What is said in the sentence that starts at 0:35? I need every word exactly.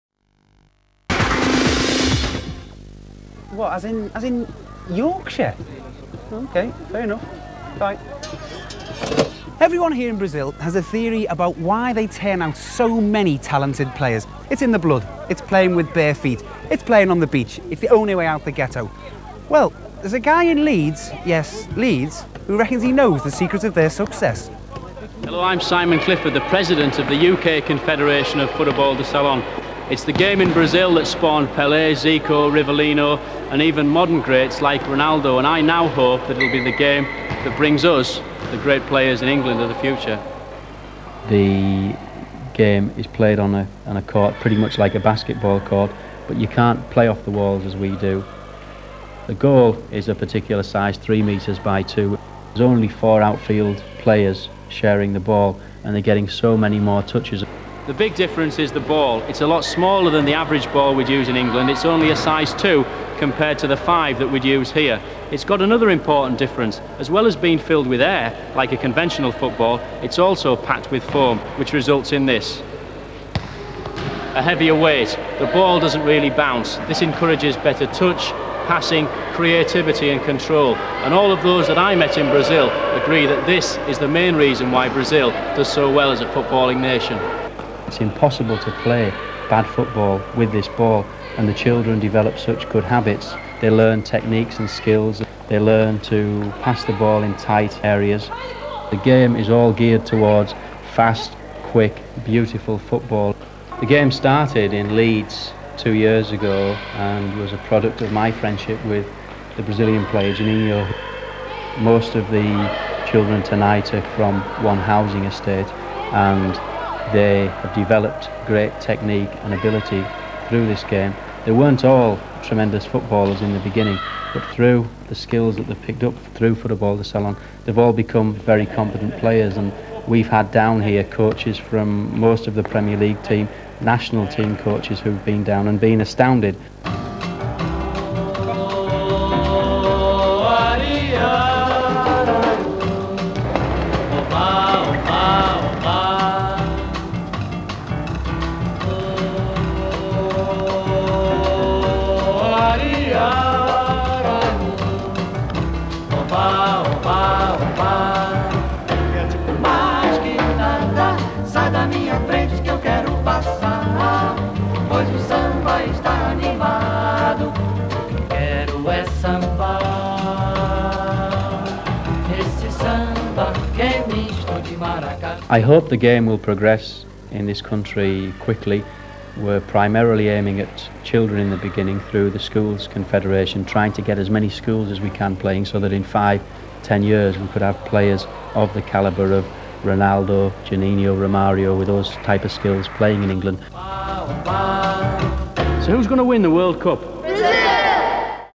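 And I now hope that it'll be the game that brings us the great players in England of the future.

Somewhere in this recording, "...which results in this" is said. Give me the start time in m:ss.
1:11.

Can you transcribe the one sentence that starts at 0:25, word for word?
Hello, I'm Simon Clifford, the president of the UK Confederation of Futebol de Salao.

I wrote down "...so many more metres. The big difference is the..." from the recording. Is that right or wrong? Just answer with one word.
wrong.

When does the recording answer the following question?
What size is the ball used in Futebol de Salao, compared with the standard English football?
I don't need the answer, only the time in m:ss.
1:02.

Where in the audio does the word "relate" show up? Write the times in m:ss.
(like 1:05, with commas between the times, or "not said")
not said.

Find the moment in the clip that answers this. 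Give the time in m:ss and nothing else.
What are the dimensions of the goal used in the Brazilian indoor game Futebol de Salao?
0:50.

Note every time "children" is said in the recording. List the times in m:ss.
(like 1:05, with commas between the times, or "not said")
1:31, 1:53, 3:01.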